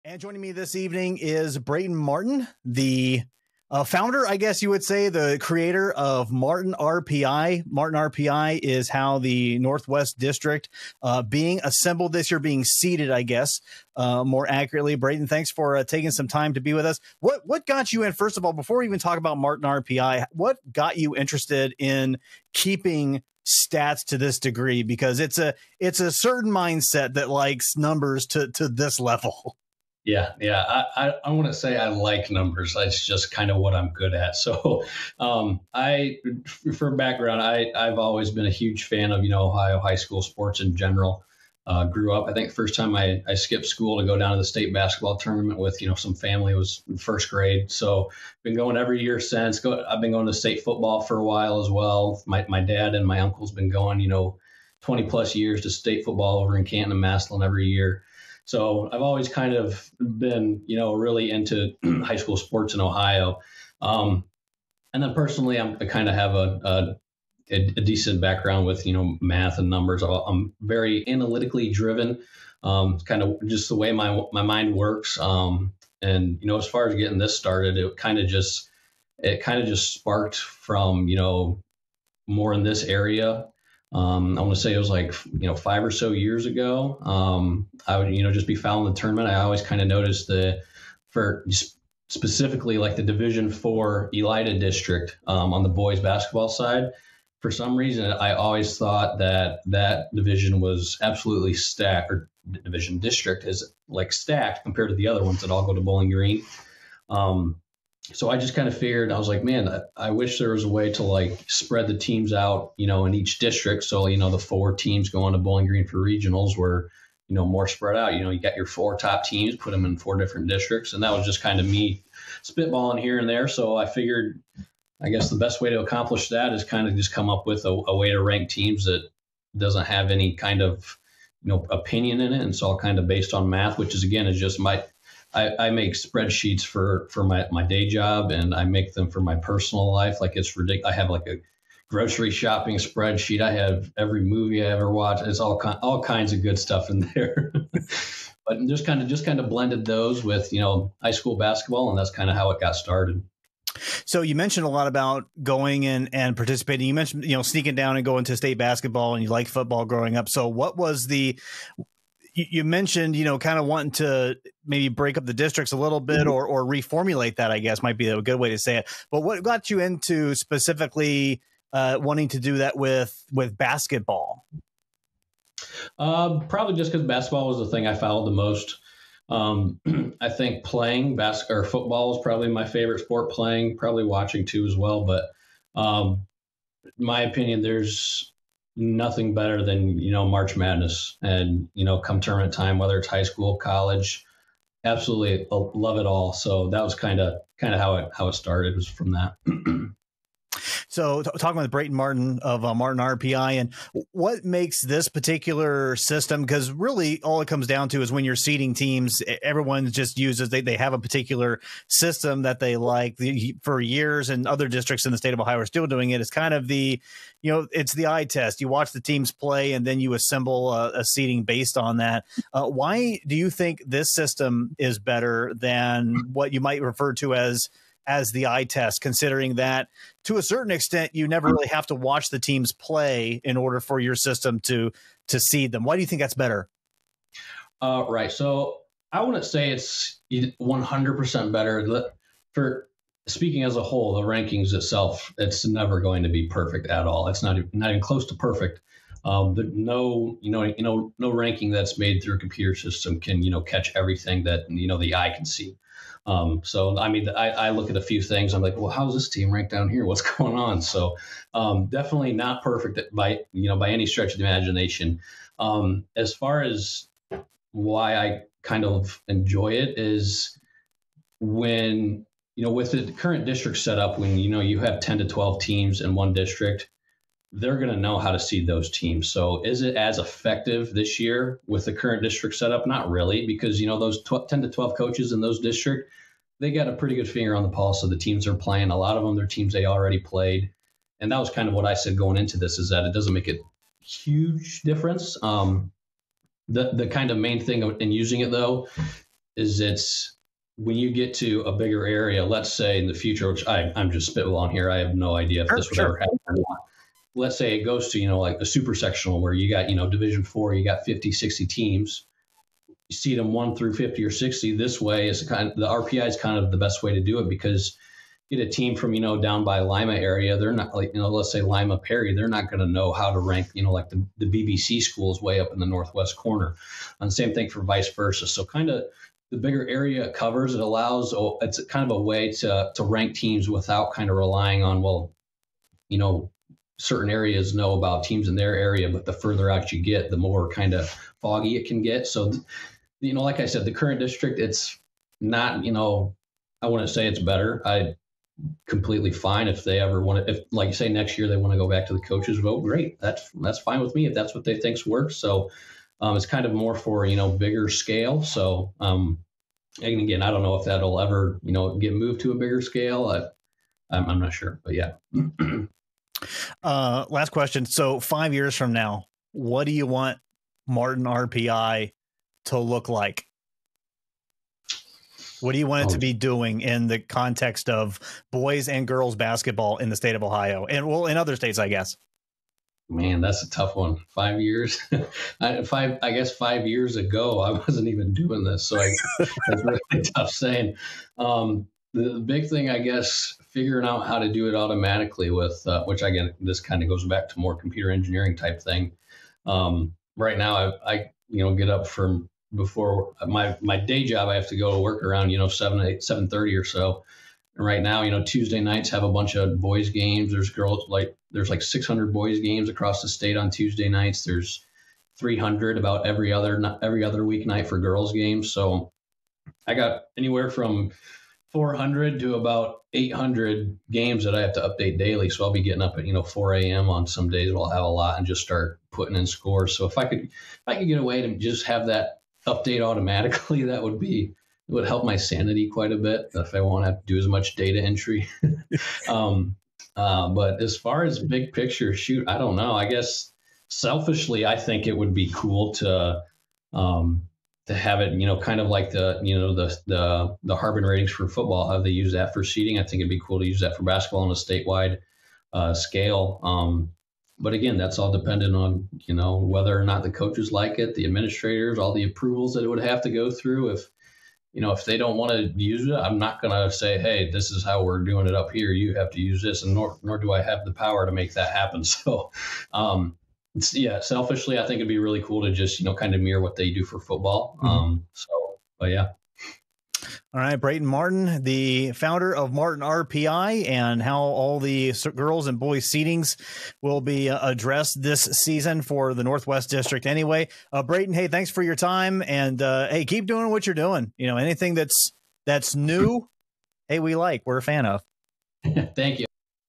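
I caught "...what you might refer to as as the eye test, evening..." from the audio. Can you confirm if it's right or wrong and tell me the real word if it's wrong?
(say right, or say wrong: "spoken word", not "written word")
wrong: "considering", not "evening".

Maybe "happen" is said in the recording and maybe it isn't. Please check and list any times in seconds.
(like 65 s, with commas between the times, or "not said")
306 s, 471 s.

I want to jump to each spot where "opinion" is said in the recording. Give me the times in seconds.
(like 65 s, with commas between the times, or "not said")
131 s, 187 s.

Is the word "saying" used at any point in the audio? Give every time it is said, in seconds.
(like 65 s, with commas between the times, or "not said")
390 s.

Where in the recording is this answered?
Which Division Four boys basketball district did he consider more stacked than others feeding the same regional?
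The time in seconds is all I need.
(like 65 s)
94 s.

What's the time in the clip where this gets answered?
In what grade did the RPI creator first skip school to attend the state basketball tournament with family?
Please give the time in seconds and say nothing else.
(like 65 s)
46 s.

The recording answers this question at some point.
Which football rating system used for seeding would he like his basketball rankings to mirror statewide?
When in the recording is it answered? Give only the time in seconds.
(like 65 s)
450 s.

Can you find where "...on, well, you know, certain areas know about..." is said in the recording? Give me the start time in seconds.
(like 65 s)
334 s.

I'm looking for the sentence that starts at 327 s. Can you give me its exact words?
And same thing for vice versa.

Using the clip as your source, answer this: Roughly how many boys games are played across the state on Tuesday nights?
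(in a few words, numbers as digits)
600.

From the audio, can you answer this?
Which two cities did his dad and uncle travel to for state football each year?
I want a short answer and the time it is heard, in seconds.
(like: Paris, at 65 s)
Canton and Massillon, at 56 s.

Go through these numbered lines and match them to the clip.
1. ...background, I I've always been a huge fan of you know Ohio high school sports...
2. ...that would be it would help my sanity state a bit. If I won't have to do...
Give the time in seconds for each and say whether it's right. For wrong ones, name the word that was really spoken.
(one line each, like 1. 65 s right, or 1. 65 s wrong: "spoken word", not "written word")
1. 36 s right
2. 433 s wrong: "quite", not "state".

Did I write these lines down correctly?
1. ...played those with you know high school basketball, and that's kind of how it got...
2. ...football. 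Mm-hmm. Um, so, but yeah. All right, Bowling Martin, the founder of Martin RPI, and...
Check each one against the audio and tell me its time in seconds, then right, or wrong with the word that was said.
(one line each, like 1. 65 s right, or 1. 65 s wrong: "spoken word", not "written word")
1. 149 s wrong: "blended", not "played"
2. 477 s wrong: "Brayton", not "Bowling".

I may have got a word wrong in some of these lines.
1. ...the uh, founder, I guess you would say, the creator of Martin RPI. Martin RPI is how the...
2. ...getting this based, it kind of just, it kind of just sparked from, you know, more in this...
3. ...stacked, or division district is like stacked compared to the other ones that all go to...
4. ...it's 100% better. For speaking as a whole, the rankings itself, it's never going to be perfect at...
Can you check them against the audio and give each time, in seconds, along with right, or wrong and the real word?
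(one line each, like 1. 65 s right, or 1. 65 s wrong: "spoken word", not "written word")
1. 2 s right
2. 76 s wrong: "started", not "based"
3. 101 s right
4. 239 s right.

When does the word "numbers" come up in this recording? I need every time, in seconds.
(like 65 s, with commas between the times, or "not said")
27 s, 32 s, 69 s.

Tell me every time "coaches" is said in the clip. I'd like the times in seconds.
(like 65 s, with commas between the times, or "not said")
284 s, 352 s, 460 s.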